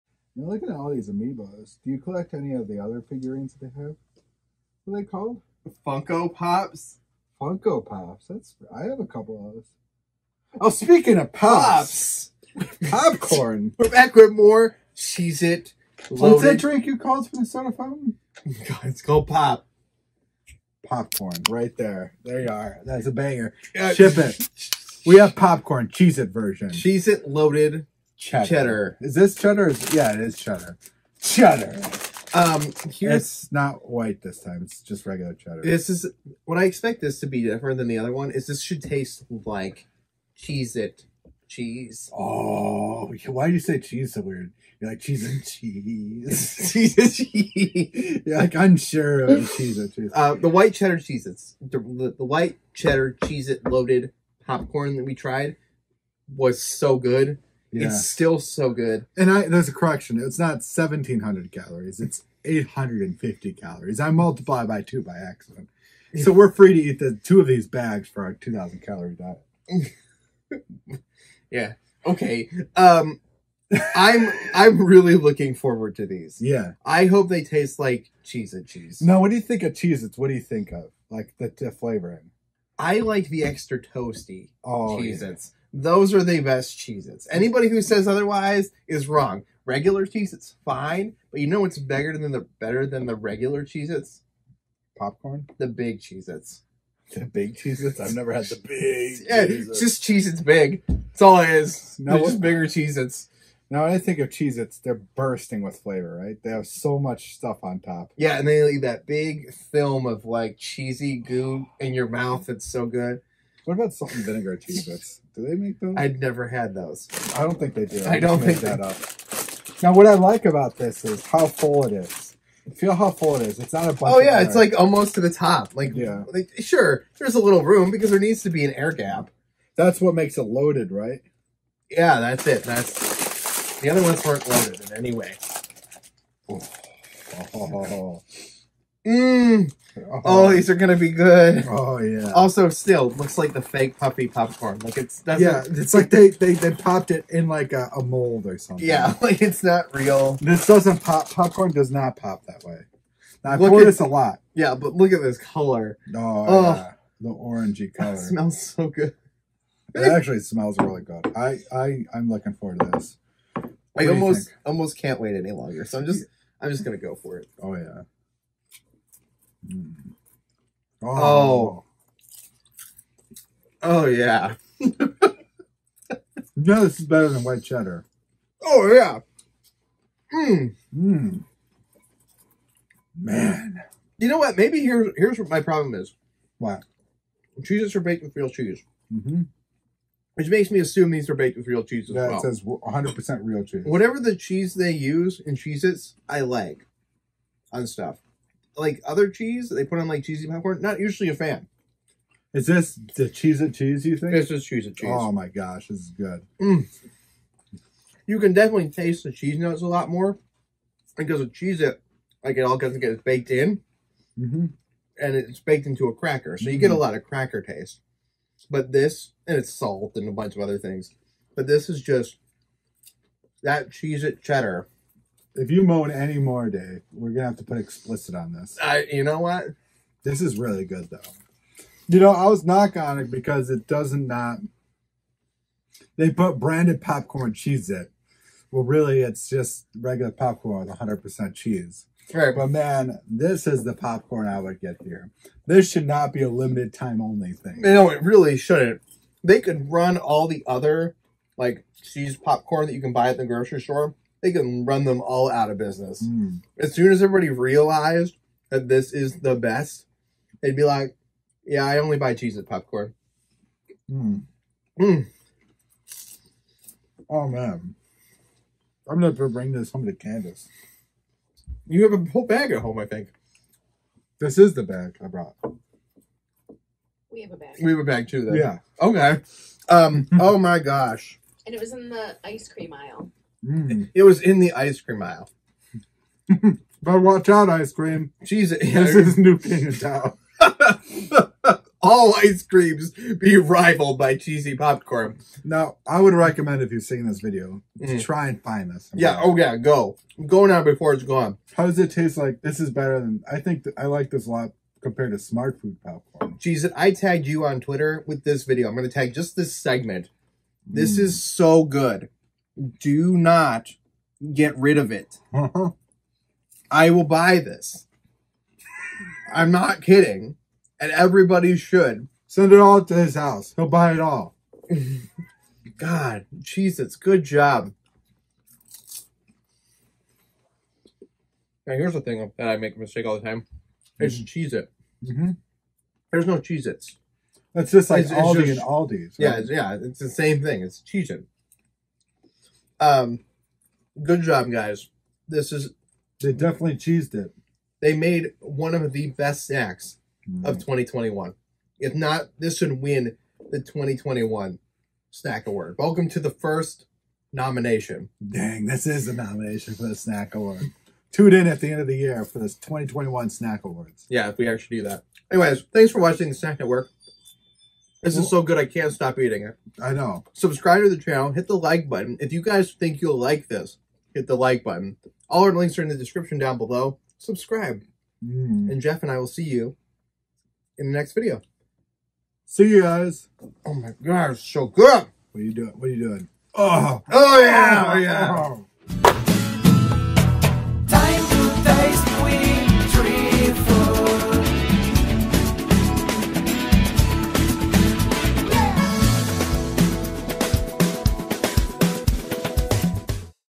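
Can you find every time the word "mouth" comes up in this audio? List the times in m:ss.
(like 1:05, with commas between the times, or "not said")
1:52.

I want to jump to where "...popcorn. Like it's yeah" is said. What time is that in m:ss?
2:24.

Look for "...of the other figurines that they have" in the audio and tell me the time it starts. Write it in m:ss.
0:02.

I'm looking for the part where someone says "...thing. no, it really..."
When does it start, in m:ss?
4:07.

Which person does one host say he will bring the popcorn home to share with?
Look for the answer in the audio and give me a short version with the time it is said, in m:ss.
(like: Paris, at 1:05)
Candace, at 4:30.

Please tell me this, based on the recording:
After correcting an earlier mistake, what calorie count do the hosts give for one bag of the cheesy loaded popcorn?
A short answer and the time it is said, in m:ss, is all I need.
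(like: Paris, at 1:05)
850, at 1:02.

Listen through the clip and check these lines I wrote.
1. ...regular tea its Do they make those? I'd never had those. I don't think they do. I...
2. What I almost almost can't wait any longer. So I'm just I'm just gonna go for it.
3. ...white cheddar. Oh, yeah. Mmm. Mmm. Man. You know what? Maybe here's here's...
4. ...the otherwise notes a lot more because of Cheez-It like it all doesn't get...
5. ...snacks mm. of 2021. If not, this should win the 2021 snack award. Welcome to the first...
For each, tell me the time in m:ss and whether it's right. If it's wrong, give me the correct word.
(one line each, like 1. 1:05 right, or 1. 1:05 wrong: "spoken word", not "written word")
1. 1:54 wrong: "vinegar", not "regular"
2. 2:43 right
3. 2:57 right
4. 3:29 wrong: "cheese", not "otherwise"
5. 5:49 right.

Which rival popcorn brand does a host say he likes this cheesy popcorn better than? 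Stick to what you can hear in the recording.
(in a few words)
Smartfood.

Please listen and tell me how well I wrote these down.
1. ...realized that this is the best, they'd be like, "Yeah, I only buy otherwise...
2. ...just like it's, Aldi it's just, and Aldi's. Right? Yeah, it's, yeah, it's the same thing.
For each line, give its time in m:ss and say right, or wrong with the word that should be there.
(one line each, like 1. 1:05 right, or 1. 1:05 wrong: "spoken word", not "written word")
1. 4:17 wrong: "cheese", not "otherwise"
2. 5:37 right.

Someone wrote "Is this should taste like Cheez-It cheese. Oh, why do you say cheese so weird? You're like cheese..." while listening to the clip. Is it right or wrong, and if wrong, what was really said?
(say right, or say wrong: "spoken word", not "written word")
right.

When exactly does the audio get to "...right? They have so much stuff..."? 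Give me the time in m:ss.
1:46.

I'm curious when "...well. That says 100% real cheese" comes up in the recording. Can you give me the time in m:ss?
3:12.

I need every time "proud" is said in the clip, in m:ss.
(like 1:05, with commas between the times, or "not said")
not said.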